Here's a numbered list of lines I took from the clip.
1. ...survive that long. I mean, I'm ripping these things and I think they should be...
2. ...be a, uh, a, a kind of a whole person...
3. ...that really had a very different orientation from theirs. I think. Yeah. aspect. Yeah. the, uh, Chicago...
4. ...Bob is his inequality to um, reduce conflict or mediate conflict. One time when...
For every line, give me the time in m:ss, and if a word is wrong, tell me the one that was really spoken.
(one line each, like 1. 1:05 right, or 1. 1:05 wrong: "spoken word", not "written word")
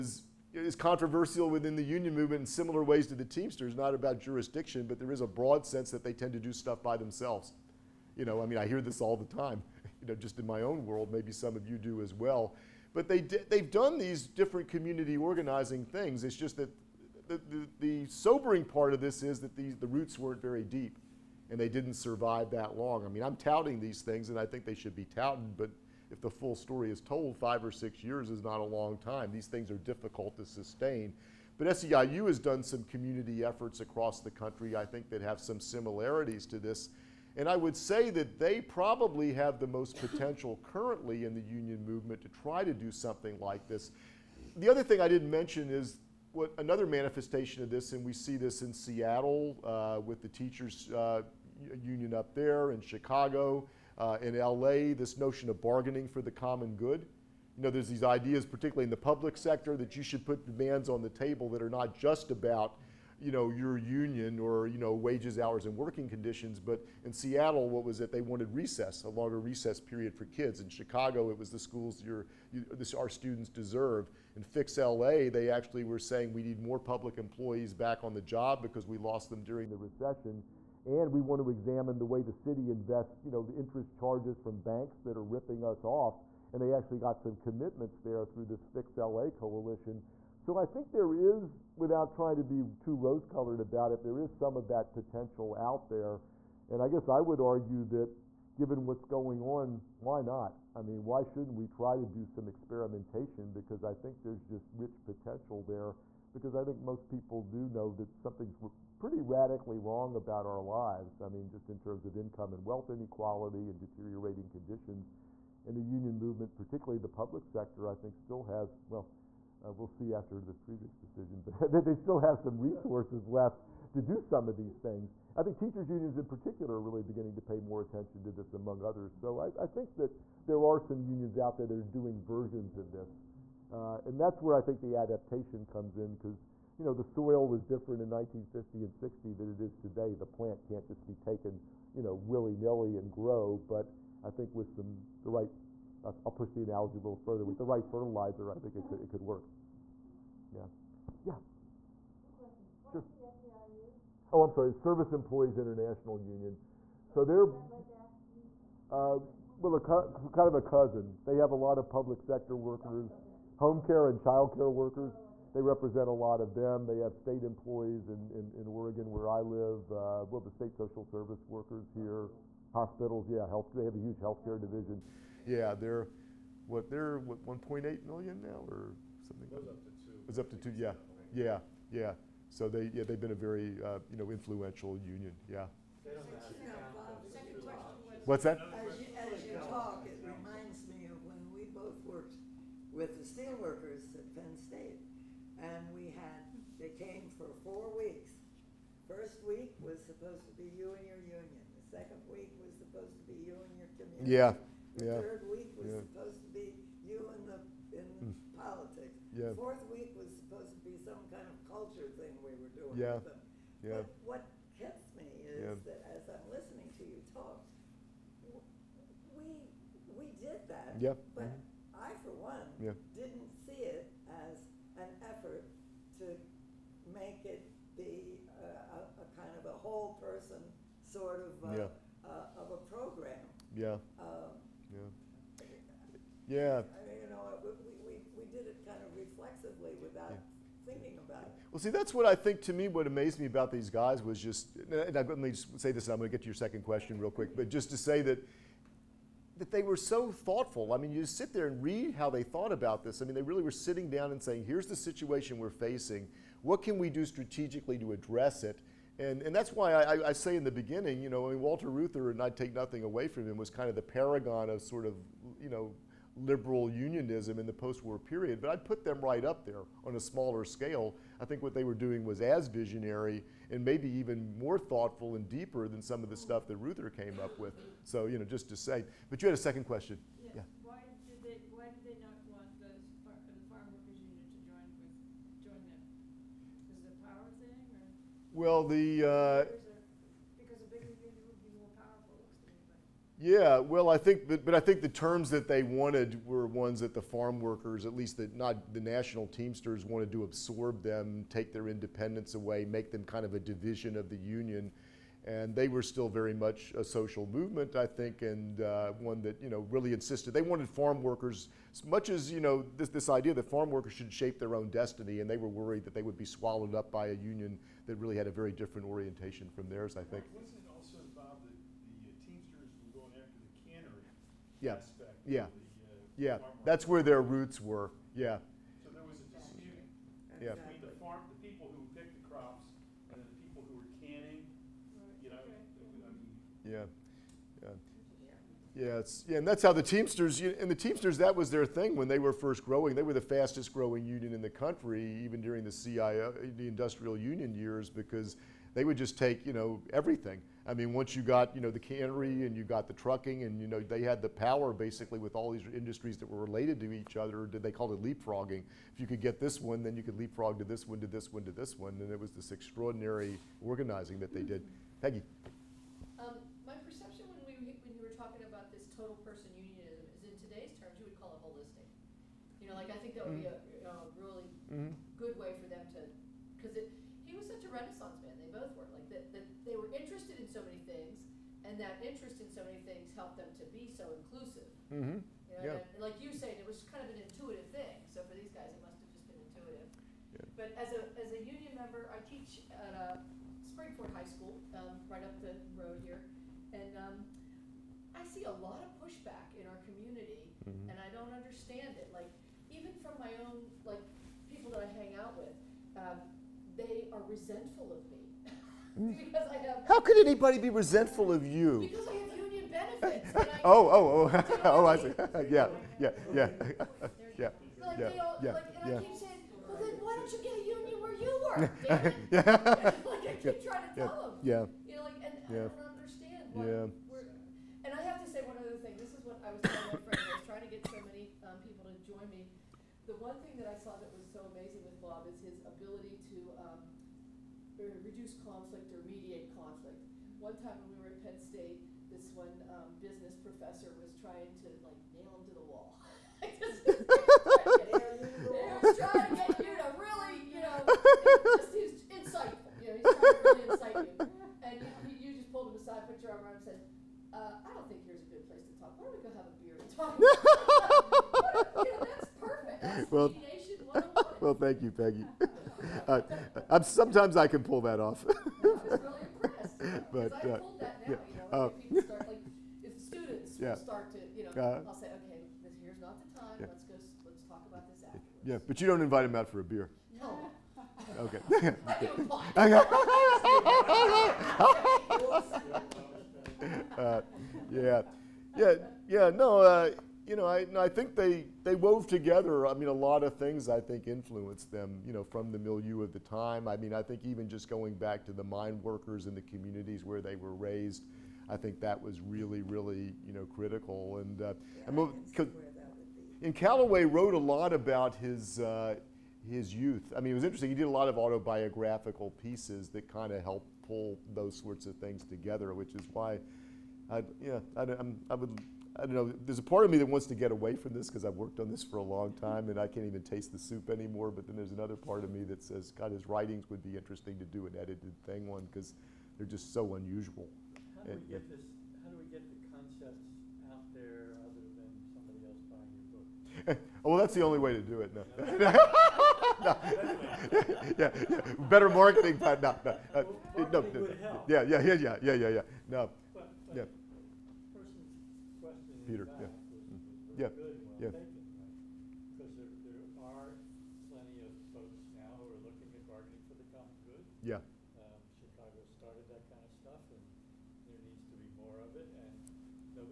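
1. 0:21 wrong: "touting", not "ripping"
2. 3:47 right
3. 5:18 wrong: "Yeah", not "Chicago"
4. 7:15 wrong: "ability", not "inequality".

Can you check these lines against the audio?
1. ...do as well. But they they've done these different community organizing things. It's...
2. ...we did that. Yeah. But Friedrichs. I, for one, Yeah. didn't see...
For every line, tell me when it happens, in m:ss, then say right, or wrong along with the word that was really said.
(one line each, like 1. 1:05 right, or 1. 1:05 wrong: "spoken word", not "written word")
1. 0:11 right
2. 3:40 wrong: "Mhm", not "Friedrichs".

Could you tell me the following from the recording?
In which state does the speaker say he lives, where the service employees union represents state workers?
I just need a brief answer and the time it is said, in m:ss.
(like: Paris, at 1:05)
Oregon, at 2:48.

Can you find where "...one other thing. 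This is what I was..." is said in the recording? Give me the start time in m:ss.
7:08.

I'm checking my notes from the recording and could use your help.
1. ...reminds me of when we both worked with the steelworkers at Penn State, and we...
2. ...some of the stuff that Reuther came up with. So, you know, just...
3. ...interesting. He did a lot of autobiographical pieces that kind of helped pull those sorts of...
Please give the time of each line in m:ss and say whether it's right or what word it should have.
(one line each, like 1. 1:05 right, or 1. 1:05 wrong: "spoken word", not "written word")
1. 3:10 right
2. 4:36 right
3. 8:30 right.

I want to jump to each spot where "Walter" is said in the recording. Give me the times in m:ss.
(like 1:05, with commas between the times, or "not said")
4:21.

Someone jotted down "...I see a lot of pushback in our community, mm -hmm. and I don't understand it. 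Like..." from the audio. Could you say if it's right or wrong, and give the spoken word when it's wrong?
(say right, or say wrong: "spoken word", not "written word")
right.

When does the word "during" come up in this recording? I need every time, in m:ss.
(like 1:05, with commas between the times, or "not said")
1:19, 5:45.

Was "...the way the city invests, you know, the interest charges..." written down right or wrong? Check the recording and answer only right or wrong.
right.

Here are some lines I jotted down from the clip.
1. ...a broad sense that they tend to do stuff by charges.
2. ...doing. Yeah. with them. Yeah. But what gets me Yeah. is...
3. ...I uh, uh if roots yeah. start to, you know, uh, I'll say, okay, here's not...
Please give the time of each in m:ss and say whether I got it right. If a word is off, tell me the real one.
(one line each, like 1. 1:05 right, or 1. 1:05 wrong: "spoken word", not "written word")
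1. 0:05 wrong: "themselves", not "charges"
2. 3:32 right
3. 7:50 wrong: "students", not "roots".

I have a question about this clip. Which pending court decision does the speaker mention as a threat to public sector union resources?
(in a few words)
Friedrichs.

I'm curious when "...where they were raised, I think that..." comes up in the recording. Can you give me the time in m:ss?
8:20.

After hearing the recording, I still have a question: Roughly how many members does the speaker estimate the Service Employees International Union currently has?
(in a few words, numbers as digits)
1.8 million.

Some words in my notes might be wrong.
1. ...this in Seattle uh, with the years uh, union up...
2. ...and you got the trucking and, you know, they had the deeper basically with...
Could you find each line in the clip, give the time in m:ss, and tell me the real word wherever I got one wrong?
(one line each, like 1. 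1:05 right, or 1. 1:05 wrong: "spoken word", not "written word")
1. 0:48 wrong: "teachers", not "years"
2. 5:52 wrong: "power", not "deeper".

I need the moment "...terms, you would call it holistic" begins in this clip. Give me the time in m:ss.
6:10.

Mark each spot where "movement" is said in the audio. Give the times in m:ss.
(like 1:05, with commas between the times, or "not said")
0:02, 0:41, 1:56, 5:07.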